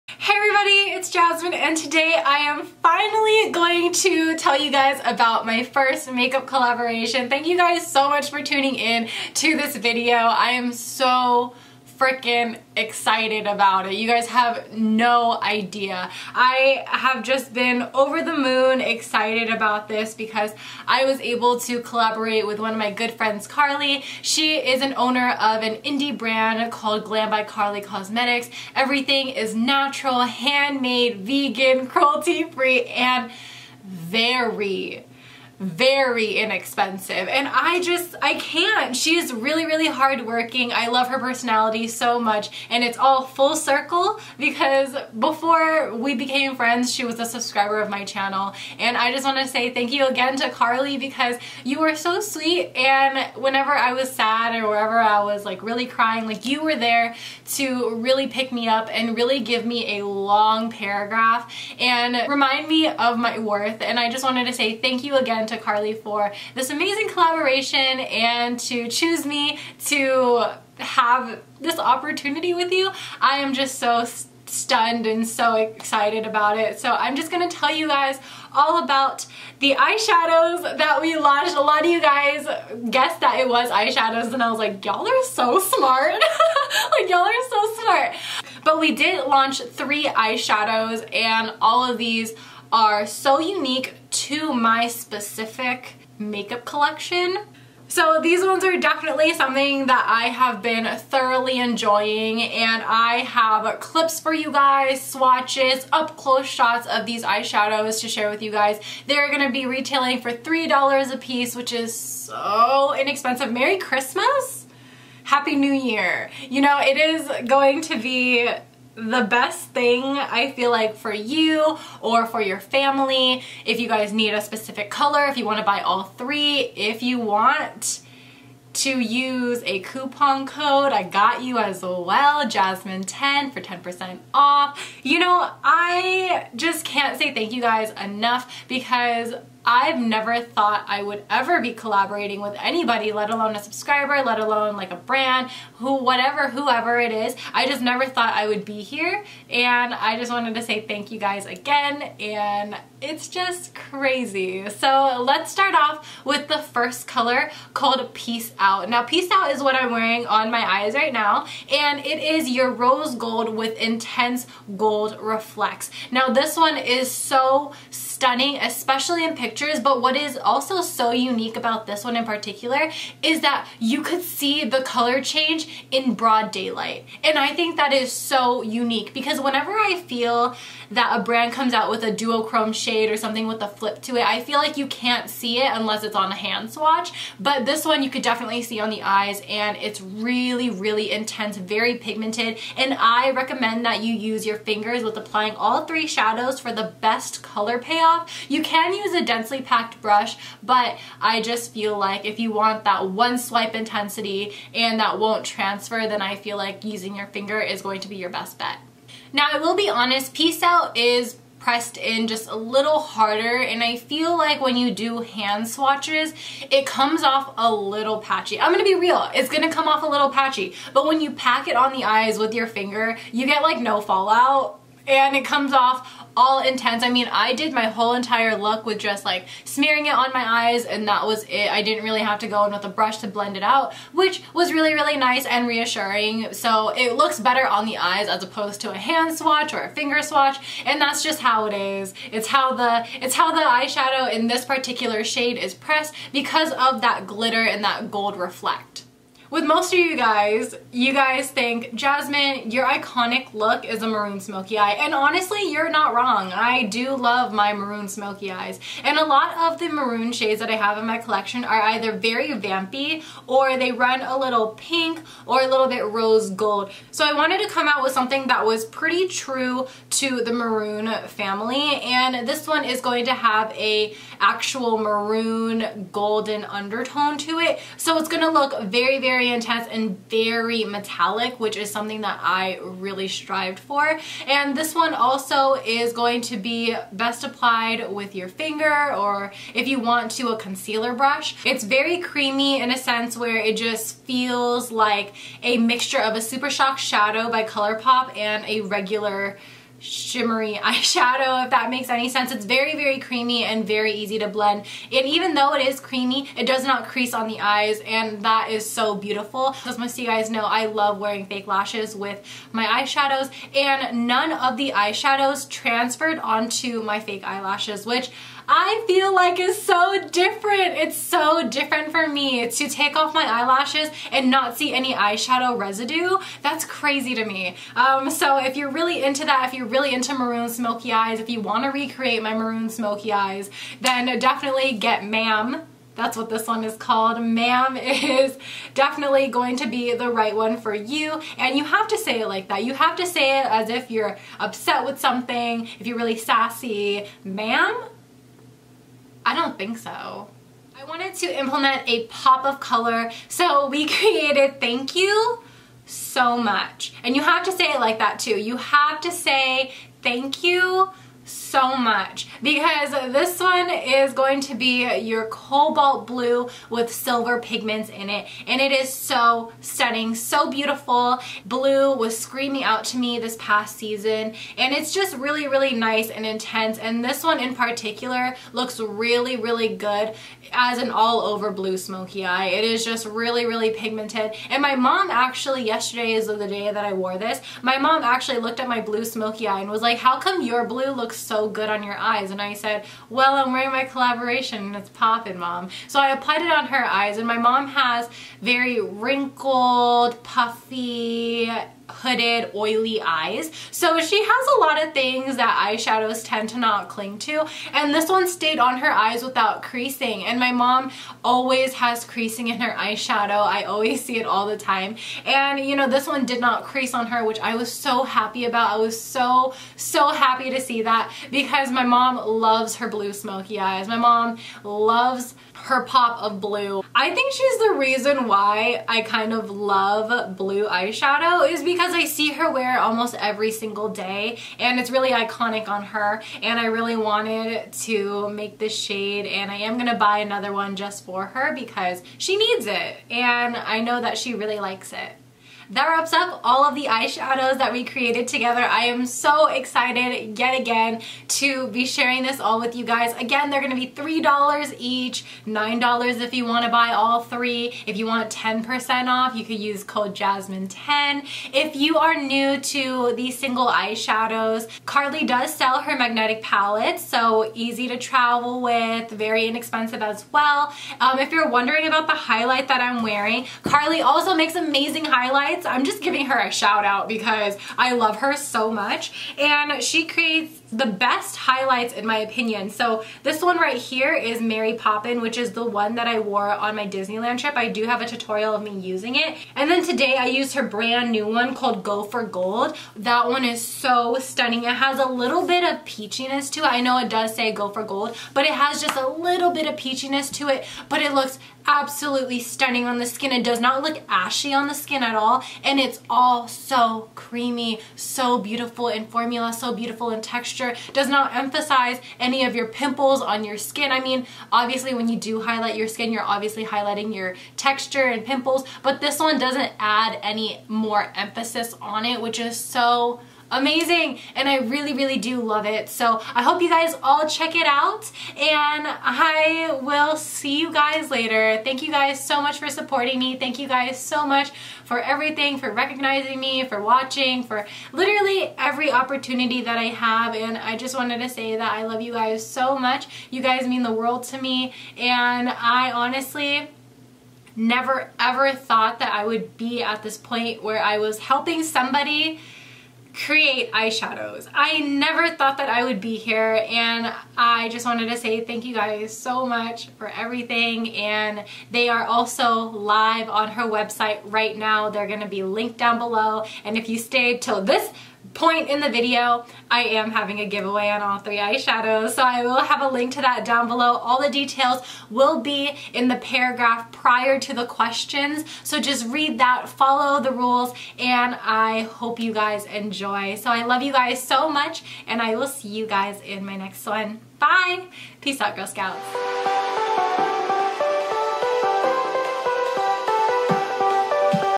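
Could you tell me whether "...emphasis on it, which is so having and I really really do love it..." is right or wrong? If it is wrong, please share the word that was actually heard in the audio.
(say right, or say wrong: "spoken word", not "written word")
wrong: "amazing", not "having".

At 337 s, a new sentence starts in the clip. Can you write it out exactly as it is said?
Ma'am is definitely going to be the right one for you.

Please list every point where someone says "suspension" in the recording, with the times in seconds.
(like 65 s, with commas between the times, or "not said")
not said.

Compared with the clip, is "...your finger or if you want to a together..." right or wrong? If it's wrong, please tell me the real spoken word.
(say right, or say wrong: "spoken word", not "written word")
wrong: "concealer", not "together".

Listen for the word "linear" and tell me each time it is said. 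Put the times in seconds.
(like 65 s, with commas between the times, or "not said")
not said.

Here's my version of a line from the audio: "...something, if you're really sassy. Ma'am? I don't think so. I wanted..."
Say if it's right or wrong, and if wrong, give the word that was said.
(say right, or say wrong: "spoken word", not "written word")
right.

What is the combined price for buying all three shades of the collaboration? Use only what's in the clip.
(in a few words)
$9.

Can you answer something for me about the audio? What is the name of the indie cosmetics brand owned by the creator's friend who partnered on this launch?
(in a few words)
Glam by Karlee Cosmetics.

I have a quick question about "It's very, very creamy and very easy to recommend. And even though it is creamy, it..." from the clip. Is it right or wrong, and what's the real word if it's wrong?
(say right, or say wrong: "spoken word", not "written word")
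wrong: "blend", not "recommend".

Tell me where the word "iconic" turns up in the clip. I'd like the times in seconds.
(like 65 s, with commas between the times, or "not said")
252 s, 435 s.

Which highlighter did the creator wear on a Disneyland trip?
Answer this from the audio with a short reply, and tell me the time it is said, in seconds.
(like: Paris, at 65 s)
Mary Poppin, at 484 s.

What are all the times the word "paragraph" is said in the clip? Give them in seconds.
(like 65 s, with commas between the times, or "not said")
60 s, 576 s.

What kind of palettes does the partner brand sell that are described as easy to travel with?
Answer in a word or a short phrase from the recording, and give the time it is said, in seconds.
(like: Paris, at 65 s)
magnetic palettes, at 466 s.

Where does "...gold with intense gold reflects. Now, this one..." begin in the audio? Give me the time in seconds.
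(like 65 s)
163 s.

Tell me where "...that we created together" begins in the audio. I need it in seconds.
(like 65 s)
447 s.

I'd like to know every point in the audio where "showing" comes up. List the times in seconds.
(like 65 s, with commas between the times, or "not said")
not said.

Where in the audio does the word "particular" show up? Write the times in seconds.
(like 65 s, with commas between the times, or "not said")
172 s, 244 s, 377 s.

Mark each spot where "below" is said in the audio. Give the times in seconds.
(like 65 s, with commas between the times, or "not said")
566 s, 573 s.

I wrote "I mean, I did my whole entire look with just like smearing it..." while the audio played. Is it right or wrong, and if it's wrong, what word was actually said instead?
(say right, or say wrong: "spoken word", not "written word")
right.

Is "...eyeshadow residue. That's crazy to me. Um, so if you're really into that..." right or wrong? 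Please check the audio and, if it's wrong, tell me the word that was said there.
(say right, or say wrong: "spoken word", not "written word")
right.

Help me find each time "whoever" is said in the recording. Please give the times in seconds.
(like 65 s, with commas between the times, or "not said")
146 s.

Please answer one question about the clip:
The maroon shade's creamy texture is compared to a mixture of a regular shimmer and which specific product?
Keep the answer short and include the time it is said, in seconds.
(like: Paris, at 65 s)
Super Shock Shadow, at 296 s.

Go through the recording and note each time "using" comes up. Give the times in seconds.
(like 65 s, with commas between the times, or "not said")
206 s, 488 s.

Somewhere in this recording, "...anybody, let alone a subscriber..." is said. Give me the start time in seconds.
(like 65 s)
142 s.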